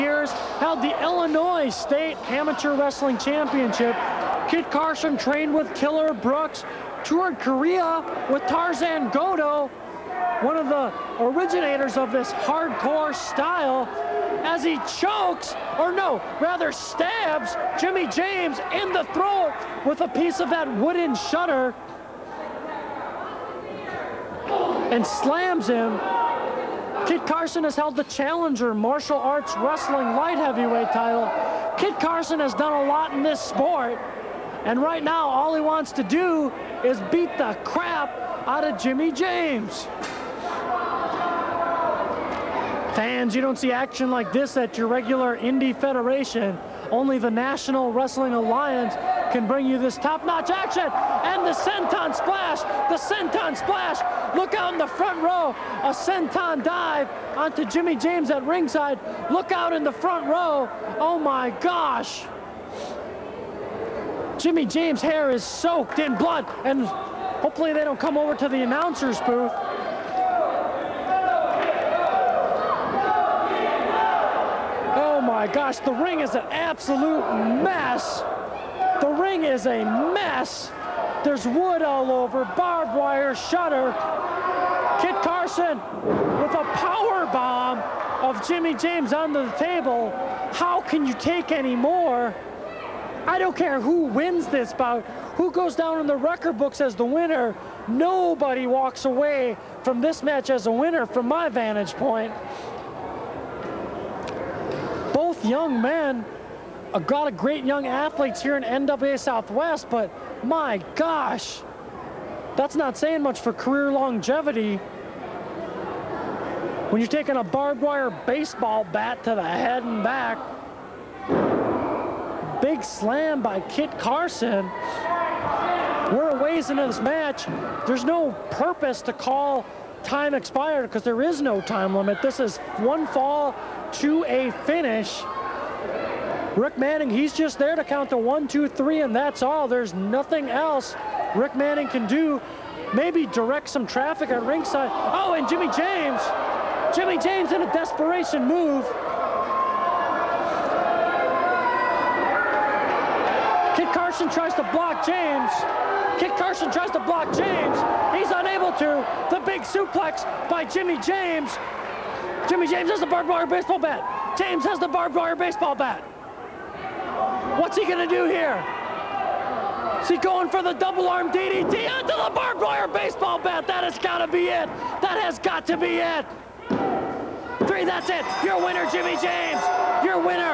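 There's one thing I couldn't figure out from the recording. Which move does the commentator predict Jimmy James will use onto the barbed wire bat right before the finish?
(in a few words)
double arm DDT.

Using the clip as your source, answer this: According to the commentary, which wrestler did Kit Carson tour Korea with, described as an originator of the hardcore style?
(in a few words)
Tarzan Goto.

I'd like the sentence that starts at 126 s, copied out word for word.
We're a ways into this match.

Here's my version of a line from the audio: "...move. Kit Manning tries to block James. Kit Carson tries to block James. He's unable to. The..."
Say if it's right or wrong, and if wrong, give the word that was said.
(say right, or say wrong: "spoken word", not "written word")
wrong: "Carson", not "Manning".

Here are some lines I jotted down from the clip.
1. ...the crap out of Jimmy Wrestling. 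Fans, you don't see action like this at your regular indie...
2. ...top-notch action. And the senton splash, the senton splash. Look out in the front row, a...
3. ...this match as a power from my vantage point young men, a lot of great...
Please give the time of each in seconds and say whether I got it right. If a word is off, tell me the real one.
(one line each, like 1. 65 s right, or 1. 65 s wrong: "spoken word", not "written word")
1. 37 s wrong: "James", not "Wrestling"
2. 49 s right
3. 100 s wrong: "winner", not "power".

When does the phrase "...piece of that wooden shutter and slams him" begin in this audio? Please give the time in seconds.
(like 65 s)
20 s.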